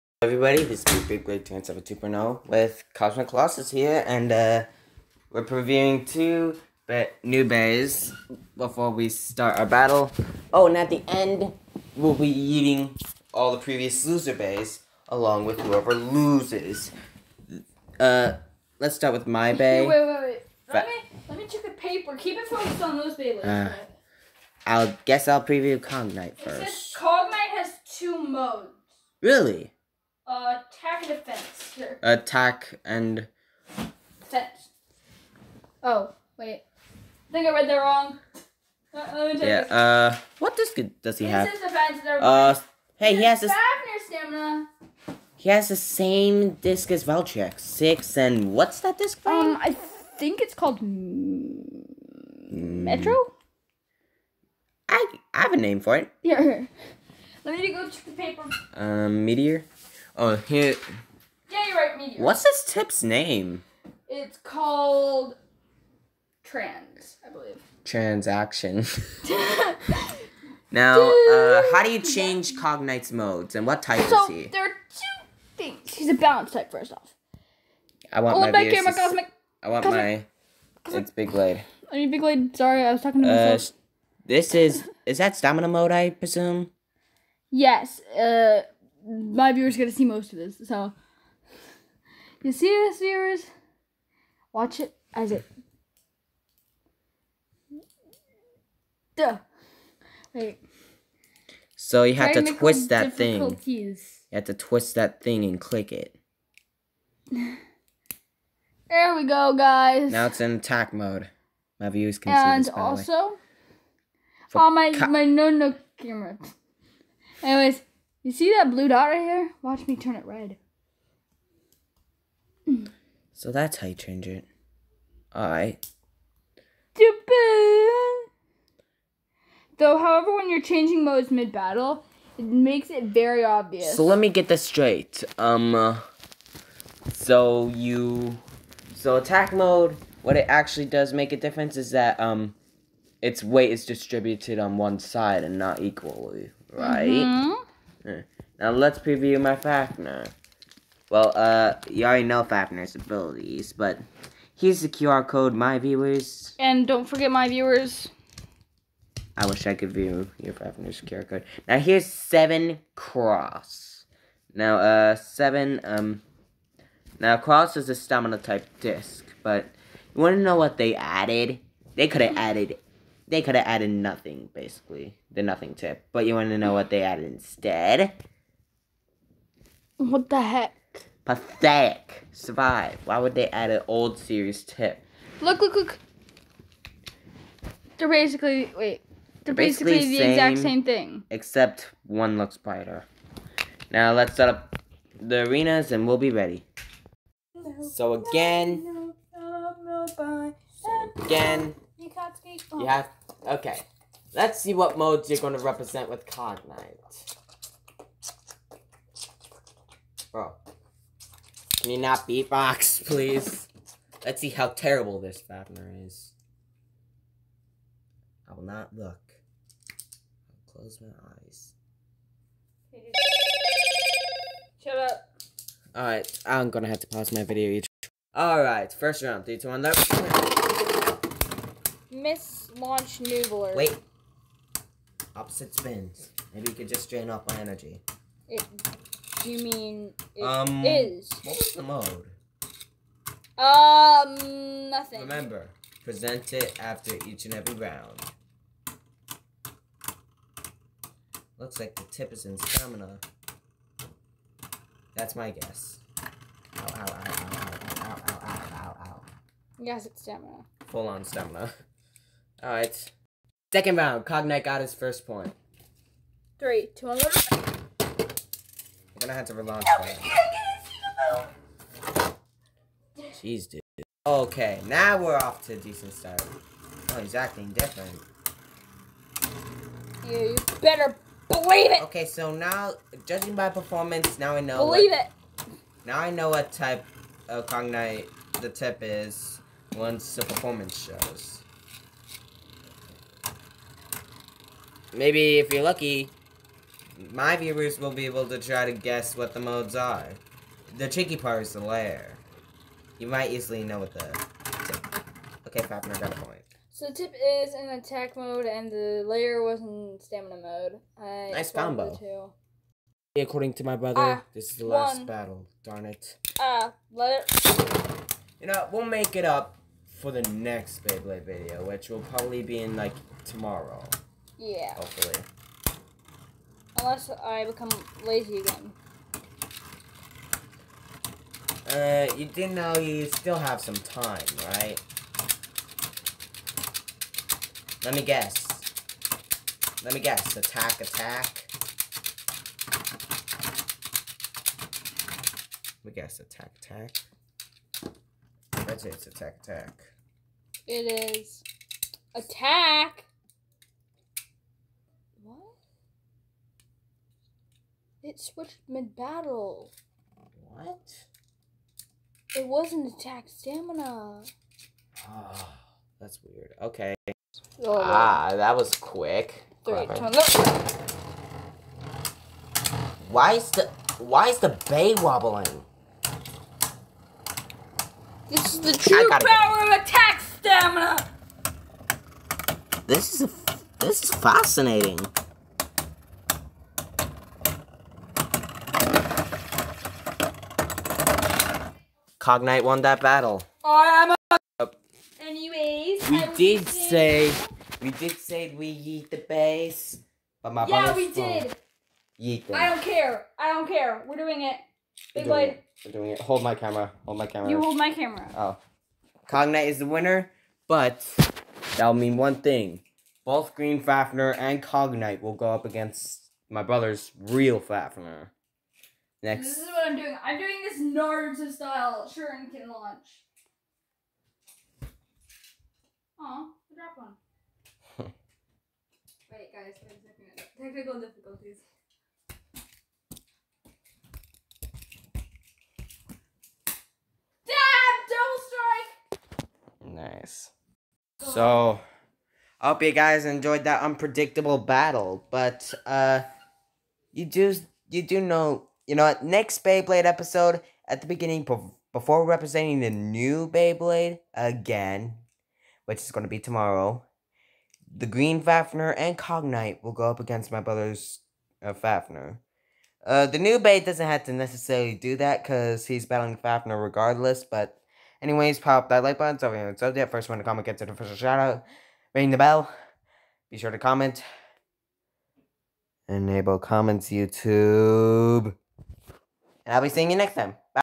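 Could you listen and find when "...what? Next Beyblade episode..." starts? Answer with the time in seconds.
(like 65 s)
449 s.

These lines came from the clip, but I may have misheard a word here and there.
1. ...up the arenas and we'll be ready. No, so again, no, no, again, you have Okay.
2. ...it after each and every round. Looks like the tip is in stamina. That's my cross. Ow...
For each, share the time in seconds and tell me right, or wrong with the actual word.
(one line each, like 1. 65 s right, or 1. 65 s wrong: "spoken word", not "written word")
1. 194 s right
2. 246 s wrong: "guess", not "cross".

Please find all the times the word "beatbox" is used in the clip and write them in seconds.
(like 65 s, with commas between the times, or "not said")
212 s.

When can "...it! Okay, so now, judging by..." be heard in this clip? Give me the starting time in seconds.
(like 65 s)
281 s.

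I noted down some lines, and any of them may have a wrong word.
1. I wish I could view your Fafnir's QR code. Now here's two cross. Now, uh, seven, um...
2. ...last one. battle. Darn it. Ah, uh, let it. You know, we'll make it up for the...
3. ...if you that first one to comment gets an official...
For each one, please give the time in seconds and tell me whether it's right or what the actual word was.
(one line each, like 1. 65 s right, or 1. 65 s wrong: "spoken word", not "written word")
1. 159 s wrong: "seven", not "two"
2. 314 s right
3. 469 s right.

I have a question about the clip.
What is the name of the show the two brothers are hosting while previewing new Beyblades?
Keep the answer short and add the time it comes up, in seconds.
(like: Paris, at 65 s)
Big Break 2.0, at 1 s.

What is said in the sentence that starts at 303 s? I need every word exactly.
You might easily know what the tip.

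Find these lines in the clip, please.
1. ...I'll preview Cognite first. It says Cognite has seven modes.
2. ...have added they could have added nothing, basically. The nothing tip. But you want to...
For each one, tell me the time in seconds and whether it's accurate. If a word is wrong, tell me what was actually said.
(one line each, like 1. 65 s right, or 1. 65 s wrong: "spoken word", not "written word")
1. 25 s wrong: "two", not "seven"
2. 172 s right.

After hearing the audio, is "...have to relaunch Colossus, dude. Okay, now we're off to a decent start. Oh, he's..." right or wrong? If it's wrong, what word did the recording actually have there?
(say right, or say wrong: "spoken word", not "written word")
wrong: "Jeez", not "Colossus".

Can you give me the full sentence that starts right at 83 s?
Uh, this is is that stamina mode, I presume.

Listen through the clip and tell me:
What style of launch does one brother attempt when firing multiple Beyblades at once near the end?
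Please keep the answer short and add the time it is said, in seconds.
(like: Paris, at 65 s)
Naruto style shuriken launch, at 420 s.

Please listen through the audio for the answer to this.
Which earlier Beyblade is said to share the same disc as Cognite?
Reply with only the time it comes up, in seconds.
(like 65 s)
47 s.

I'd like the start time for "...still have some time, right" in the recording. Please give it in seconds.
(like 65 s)
333 s.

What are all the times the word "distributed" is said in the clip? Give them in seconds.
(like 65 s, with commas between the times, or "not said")
143 s.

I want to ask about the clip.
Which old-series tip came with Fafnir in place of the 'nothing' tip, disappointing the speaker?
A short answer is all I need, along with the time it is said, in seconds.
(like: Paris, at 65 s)
Survive, at 182 s.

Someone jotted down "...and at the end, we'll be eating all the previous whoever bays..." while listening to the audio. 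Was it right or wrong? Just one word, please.
wrong.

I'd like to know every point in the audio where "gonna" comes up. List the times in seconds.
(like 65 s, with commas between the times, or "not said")
226 s, 269 s.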